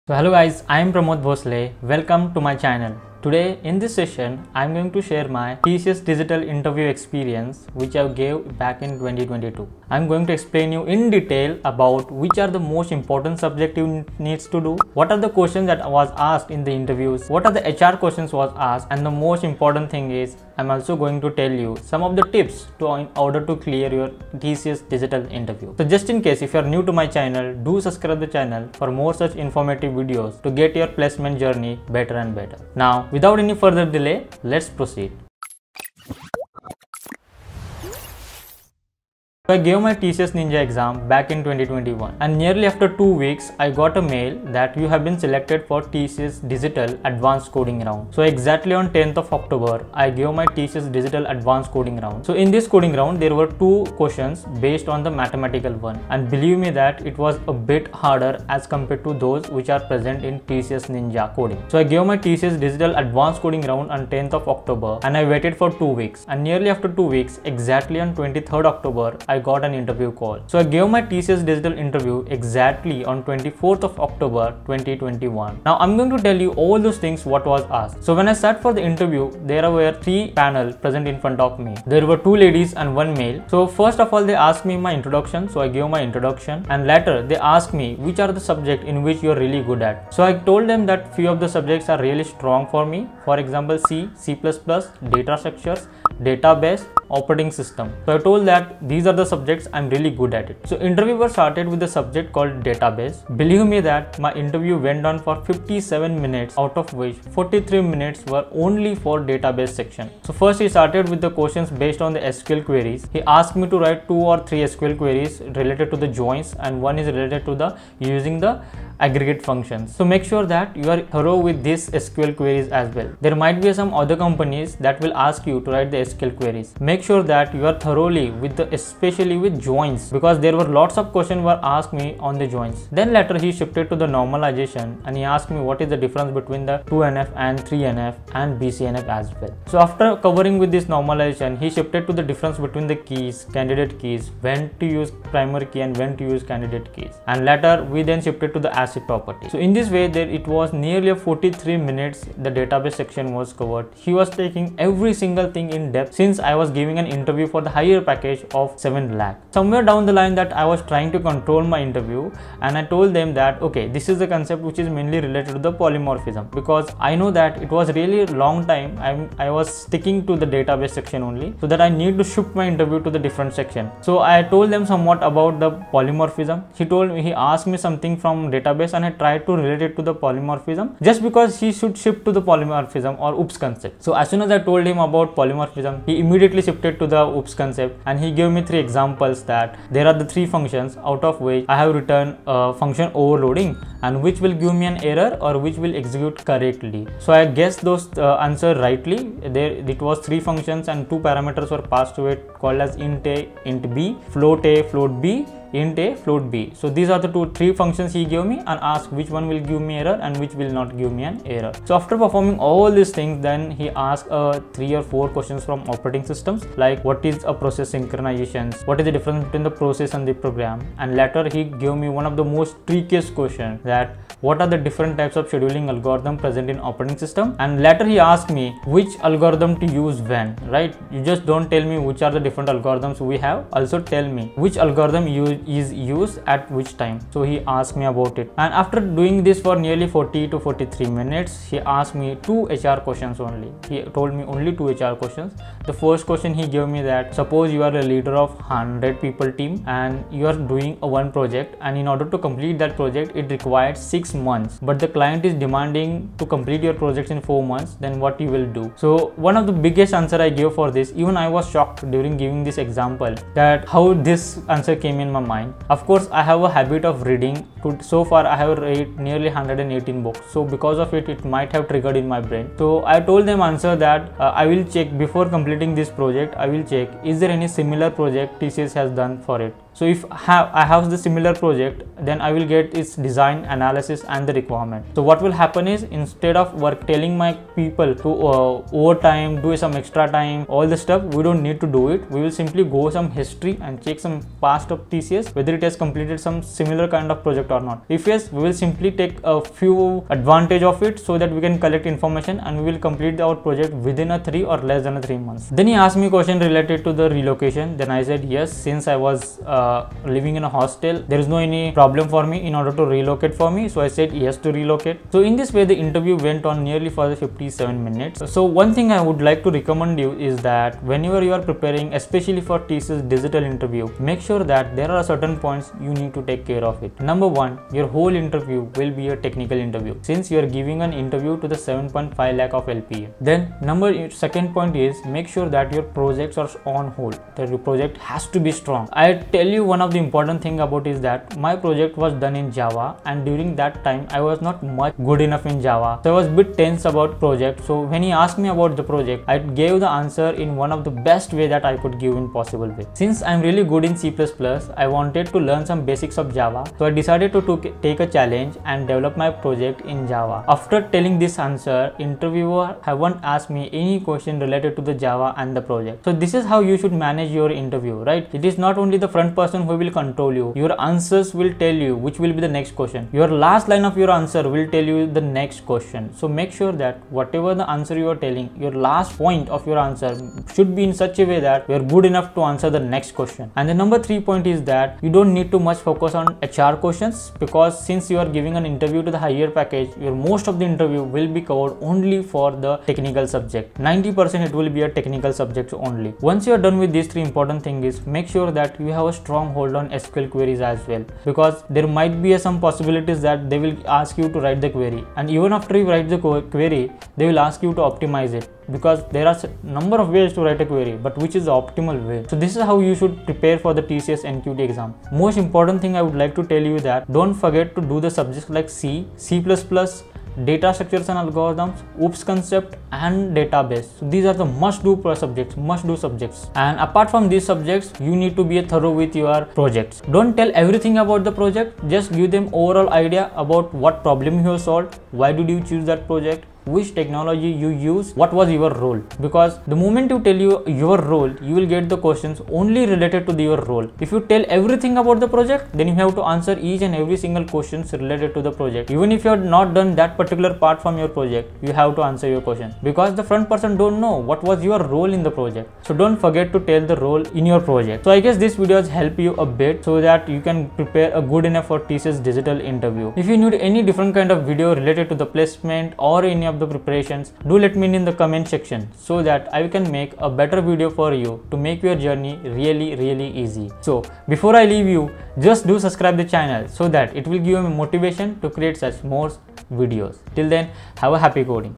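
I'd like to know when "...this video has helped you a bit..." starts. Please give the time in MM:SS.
07:38.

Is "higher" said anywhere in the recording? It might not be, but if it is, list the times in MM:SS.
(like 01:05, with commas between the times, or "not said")
02:37, 06:29.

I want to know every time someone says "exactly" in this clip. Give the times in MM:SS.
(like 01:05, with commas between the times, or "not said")
00:48, 01:07, 01:12.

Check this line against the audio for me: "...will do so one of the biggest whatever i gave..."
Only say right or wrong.
wrong.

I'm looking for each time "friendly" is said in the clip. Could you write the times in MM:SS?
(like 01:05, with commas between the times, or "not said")
not said.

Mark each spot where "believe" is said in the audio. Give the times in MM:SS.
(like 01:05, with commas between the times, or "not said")
00:56, 01:43.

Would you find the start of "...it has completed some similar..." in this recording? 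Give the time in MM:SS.
04:55.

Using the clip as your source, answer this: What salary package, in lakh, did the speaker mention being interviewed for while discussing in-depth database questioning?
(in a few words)
7 lakh.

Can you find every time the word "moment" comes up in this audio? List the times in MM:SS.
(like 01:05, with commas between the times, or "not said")
07:19.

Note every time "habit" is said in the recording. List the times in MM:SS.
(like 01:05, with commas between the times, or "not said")
04:26.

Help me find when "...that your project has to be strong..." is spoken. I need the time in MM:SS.
05:37.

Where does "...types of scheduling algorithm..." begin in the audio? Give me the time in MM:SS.
03:45.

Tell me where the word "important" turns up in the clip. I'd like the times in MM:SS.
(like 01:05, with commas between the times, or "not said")
00:12, 00:19, 05:40, 06:37, 06:55.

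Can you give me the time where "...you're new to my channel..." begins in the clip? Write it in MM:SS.
00:26.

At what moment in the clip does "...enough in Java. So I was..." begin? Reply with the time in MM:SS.
05:45.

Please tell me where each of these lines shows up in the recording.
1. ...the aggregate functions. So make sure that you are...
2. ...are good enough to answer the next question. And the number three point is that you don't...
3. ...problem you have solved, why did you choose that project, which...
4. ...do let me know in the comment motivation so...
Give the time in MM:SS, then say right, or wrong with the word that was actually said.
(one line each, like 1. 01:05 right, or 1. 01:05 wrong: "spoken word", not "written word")
1. 01:58 right
2. 06:21 right
3. 07:14 right
4. 07:47 wrong: "section", not "motivation".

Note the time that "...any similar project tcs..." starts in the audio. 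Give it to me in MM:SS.
04:37.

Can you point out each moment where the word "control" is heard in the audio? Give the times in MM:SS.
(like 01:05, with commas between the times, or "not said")
02:41, 06:10.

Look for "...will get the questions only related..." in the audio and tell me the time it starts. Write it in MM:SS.
07:21.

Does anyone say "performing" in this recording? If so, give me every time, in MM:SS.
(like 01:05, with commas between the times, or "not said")
03:32.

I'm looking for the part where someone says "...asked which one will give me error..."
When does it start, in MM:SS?
03:28.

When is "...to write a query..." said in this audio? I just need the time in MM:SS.
06:50.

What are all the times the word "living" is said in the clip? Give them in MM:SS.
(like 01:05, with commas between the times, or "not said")
05:10.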